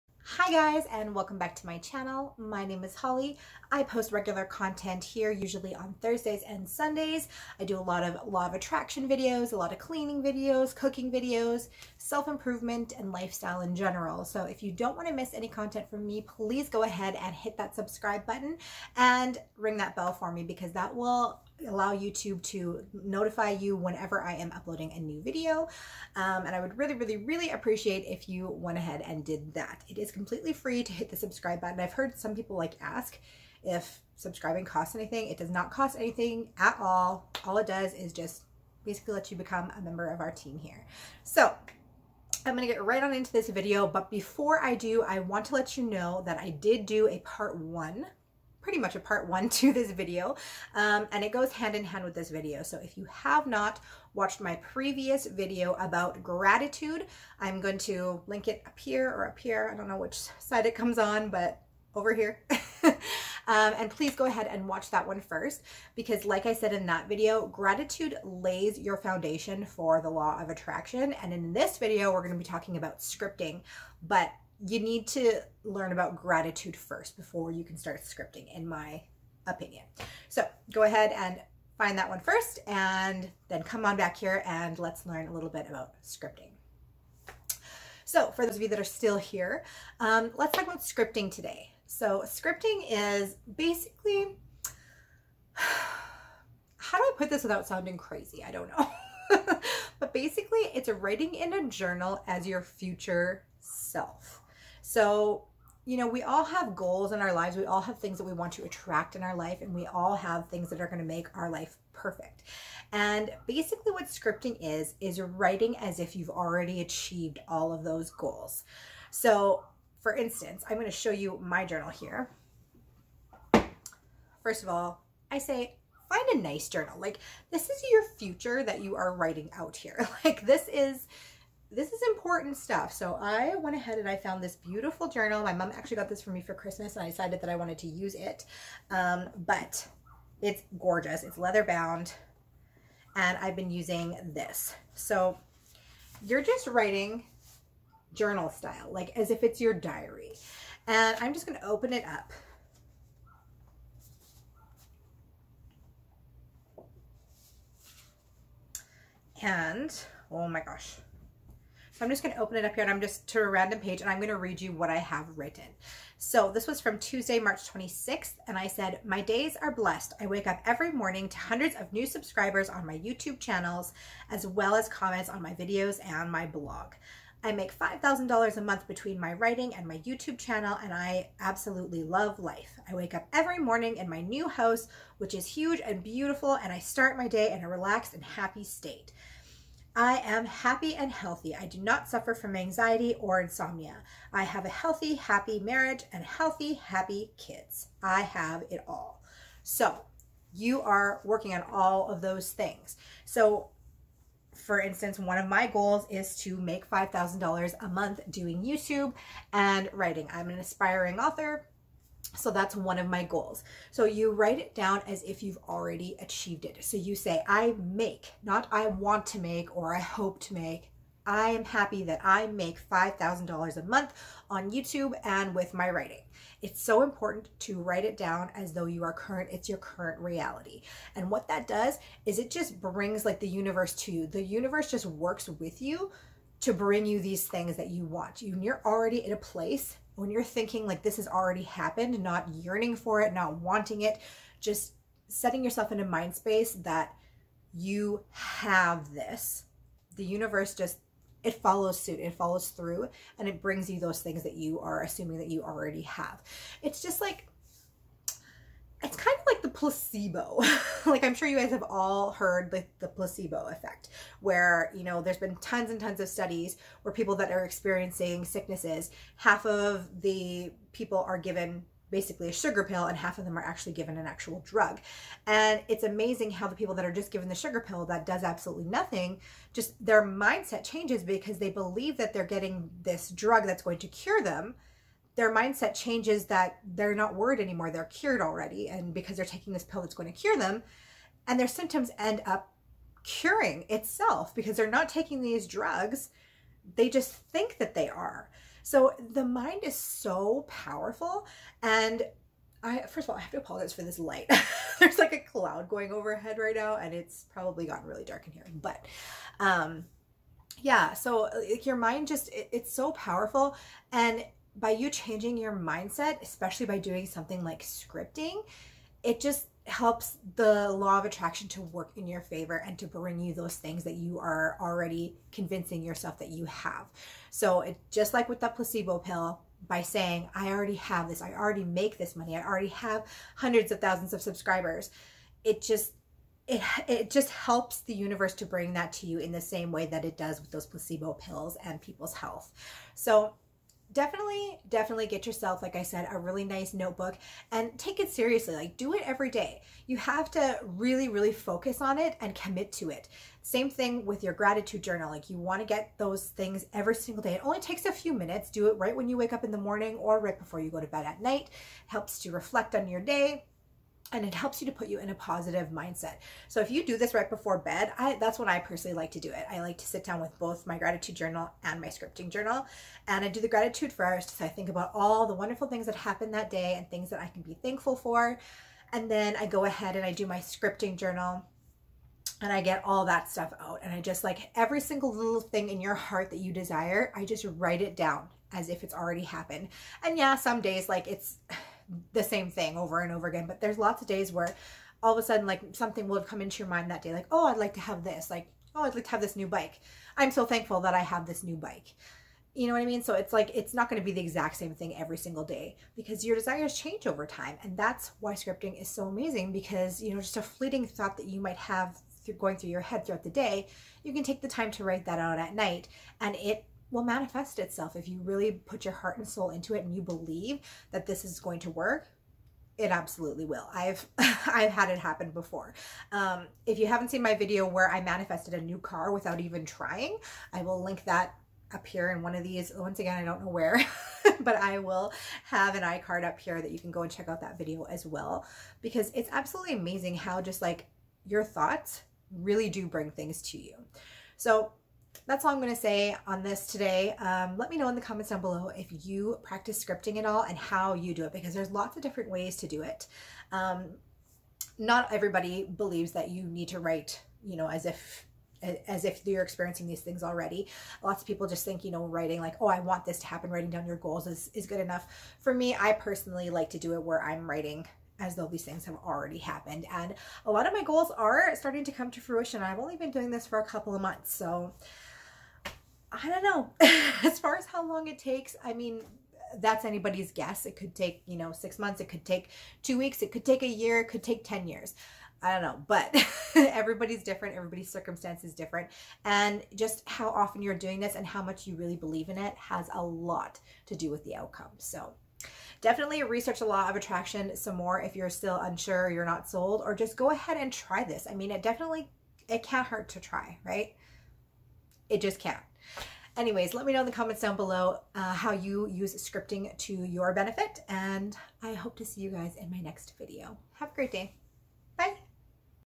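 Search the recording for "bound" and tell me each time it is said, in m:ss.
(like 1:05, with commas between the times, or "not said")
2:21.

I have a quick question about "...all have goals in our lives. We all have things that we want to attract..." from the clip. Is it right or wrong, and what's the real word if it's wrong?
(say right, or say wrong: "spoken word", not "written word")
right.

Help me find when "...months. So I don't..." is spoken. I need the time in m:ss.
7:54.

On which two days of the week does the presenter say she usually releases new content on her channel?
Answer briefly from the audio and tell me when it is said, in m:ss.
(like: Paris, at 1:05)
Thursdays and Sundays, at 0:06.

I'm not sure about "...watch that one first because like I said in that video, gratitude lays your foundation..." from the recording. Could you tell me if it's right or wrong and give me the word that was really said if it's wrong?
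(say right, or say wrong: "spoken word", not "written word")
right.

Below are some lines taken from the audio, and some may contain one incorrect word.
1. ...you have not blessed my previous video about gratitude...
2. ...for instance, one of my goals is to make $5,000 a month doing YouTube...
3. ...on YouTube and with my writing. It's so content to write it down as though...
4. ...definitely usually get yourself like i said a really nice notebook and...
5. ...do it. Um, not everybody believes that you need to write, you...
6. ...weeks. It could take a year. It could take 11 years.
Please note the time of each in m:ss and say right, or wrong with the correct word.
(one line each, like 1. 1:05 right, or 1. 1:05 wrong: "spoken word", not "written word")
1. 0:52 wrong: "watched", not "blessed"
2. 3:24 right
3. 3:44 wrong: "important", not "content"
4. 5:44 wrong: "definitely", not "usually"
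5. 7:32 right
6. 8:03 wrong: "10", not "11".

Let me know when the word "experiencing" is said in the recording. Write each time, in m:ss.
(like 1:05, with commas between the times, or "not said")
4:27, 7:39.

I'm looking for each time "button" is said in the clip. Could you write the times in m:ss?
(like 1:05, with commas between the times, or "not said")
0:18, 0:31.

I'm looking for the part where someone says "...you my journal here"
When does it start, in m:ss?
2:01.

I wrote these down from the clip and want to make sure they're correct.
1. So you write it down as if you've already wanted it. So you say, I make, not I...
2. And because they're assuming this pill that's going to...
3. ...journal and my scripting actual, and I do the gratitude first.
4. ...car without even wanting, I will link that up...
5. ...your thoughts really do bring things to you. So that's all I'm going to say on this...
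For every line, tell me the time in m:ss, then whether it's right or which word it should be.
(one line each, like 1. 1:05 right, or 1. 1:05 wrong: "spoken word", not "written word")
1. 3:33 wrong: "achieved", not "wanted"
2. 4:48 wrong: "taking", not "assuming"
3. 6:11 wrong: "journal", not "actual"
4. 7:08 wrong: "trying", not "wanting"
5. 7:21 right.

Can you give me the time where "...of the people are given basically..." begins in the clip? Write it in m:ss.
4:29.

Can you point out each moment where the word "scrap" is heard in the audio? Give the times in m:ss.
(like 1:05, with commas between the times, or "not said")
not said.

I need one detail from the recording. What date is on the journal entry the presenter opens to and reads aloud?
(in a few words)
Tuesday, March 26th.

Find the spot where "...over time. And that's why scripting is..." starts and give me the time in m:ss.
6:47.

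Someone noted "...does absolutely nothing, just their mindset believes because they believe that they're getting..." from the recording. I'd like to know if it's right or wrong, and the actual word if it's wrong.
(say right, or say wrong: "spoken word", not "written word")
wrong: "changes", not "believes".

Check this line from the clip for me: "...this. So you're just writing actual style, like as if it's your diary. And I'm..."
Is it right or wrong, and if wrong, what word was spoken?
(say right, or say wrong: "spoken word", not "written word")
wrong: "journal", not "actual".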